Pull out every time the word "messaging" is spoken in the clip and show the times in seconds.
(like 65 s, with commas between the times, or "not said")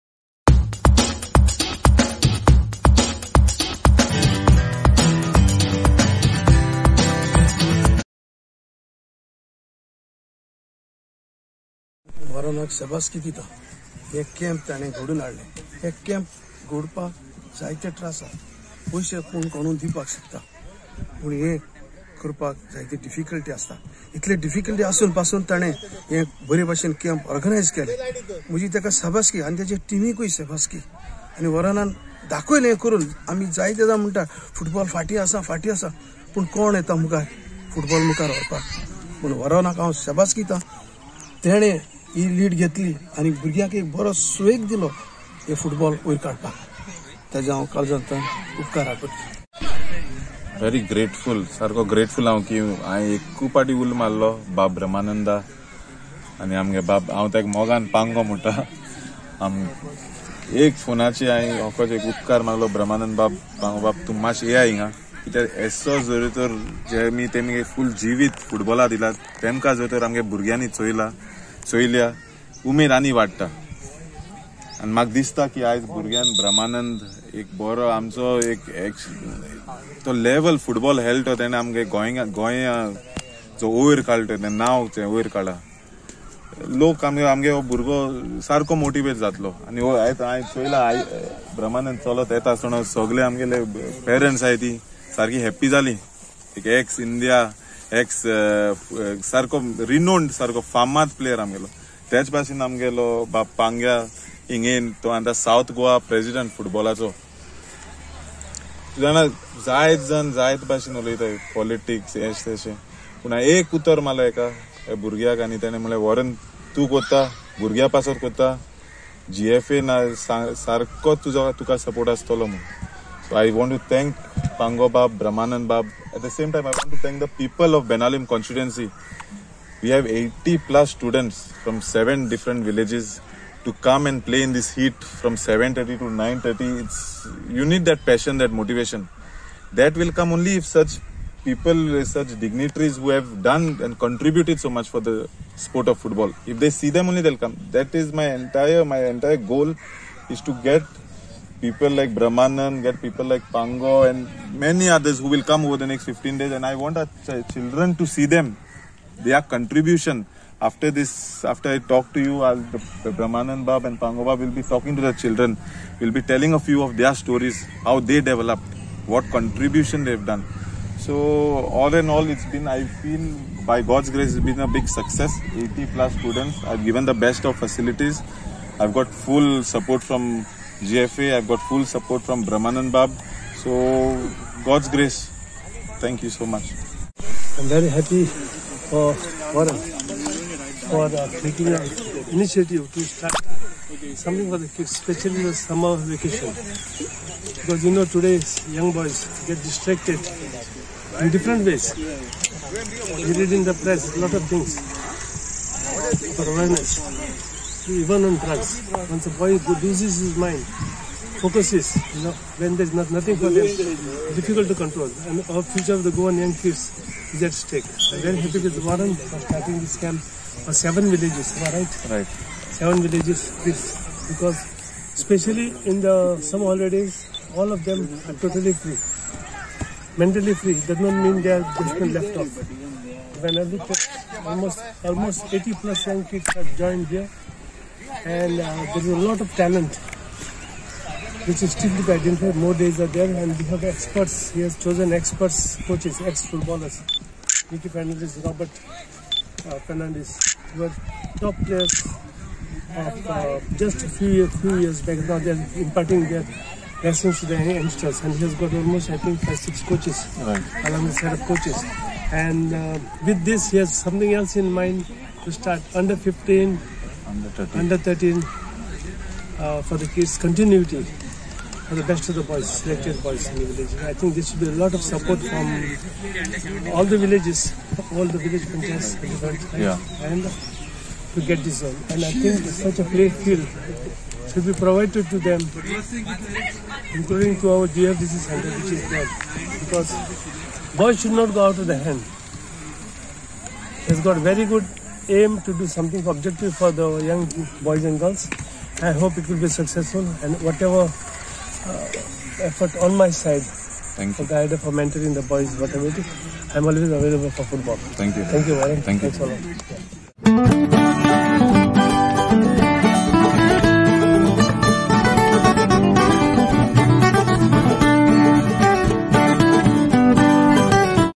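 not said.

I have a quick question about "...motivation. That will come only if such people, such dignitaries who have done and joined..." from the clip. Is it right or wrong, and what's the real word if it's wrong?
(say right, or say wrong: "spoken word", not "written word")
wrong: "contributed", not "joined".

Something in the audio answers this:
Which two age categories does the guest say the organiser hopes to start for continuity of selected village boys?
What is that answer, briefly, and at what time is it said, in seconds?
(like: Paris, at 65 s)
Under 15 and under 13, at 265 s.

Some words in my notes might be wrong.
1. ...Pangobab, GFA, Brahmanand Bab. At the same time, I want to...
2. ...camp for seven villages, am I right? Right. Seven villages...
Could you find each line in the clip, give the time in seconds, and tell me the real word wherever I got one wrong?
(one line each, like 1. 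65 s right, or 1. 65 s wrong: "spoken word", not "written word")
1. 124 s wrong: "Bab", not "GFA"
2. 219 s right.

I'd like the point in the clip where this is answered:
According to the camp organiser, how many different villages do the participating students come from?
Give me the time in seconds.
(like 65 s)
131 s.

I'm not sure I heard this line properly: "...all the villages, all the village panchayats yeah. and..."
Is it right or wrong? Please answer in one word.
right.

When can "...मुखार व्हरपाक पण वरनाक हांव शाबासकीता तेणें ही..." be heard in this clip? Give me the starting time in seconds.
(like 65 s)
38 s.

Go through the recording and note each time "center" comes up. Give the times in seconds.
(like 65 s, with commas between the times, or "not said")
288 s.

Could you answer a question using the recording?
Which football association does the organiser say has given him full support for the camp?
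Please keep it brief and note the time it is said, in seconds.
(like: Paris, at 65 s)
GFA, at 180 s.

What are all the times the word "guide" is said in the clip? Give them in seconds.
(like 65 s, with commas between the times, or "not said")
304 s.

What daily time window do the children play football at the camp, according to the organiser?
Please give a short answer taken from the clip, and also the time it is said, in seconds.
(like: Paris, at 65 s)
7:30 to 9:30, at 135 s.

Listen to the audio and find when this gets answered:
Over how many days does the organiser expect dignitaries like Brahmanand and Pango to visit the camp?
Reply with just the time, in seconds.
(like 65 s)
155 s.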